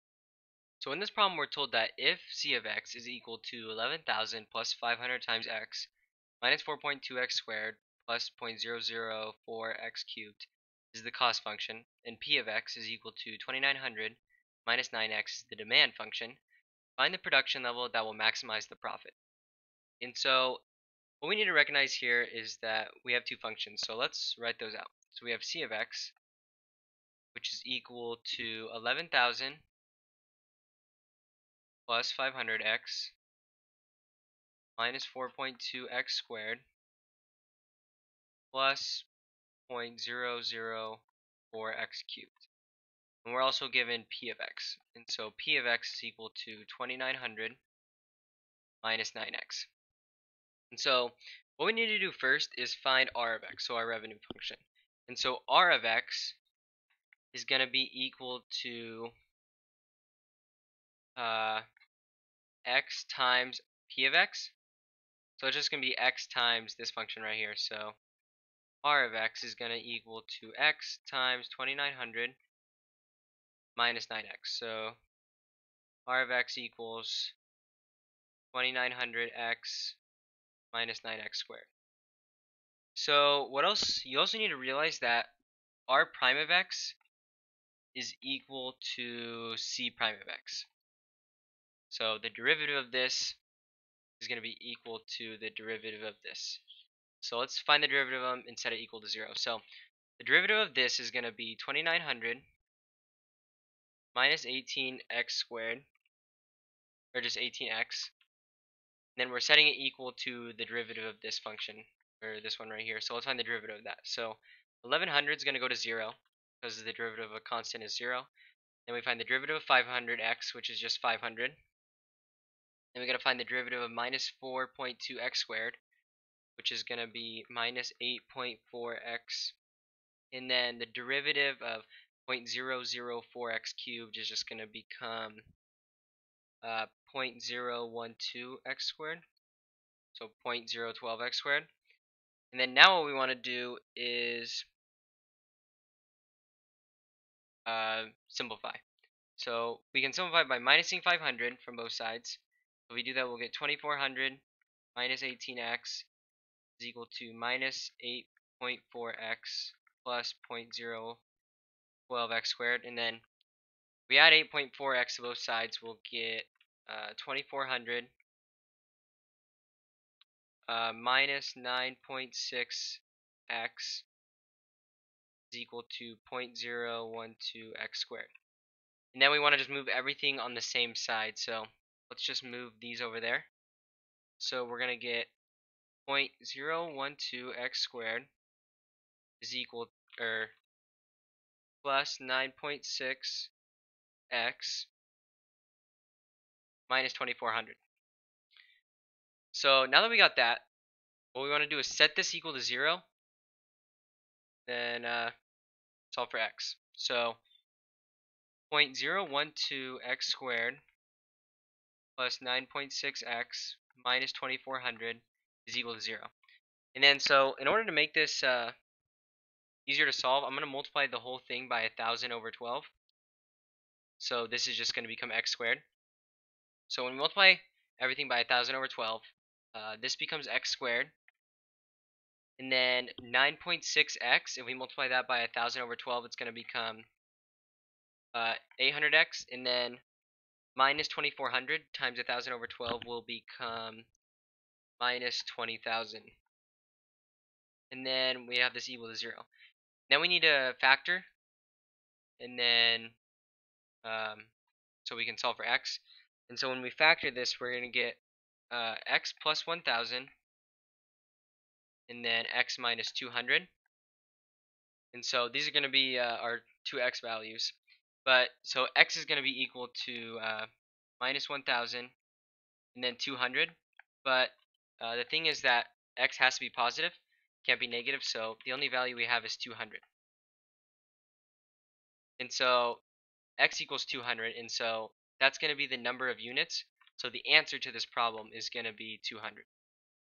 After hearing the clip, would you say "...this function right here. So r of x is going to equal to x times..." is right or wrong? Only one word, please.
right.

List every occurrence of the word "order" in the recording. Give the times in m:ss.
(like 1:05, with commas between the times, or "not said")
3:37.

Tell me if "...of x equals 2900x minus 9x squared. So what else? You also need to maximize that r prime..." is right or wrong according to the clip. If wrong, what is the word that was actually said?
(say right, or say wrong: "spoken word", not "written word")
wrong: "realize", not "maximize".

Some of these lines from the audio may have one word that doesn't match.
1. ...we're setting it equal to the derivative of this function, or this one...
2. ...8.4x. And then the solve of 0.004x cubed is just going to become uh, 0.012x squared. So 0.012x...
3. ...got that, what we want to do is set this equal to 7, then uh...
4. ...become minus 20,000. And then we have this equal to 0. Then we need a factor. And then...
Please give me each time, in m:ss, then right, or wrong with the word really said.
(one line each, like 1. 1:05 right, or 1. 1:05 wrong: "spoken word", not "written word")
1. 1:49 right
2. 2:08 wrong: "derivative", not "solve"
3. 3:20 wrong: "0", not "7"
4. 4:03 right.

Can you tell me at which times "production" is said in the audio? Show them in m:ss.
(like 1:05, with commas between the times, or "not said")
0:17.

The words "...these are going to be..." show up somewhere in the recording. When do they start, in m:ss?
4:25.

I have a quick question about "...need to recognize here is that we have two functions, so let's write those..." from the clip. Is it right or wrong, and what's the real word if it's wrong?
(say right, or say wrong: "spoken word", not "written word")
right.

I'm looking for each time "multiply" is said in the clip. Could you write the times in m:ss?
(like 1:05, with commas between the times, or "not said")
3:40, 3:47, 3:54.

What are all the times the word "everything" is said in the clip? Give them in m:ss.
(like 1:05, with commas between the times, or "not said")
2:59, 3:47.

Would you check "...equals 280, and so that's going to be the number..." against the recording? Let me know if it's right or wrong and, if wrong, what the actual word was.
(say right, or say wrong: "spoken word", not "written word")
wrong: "200", not "280".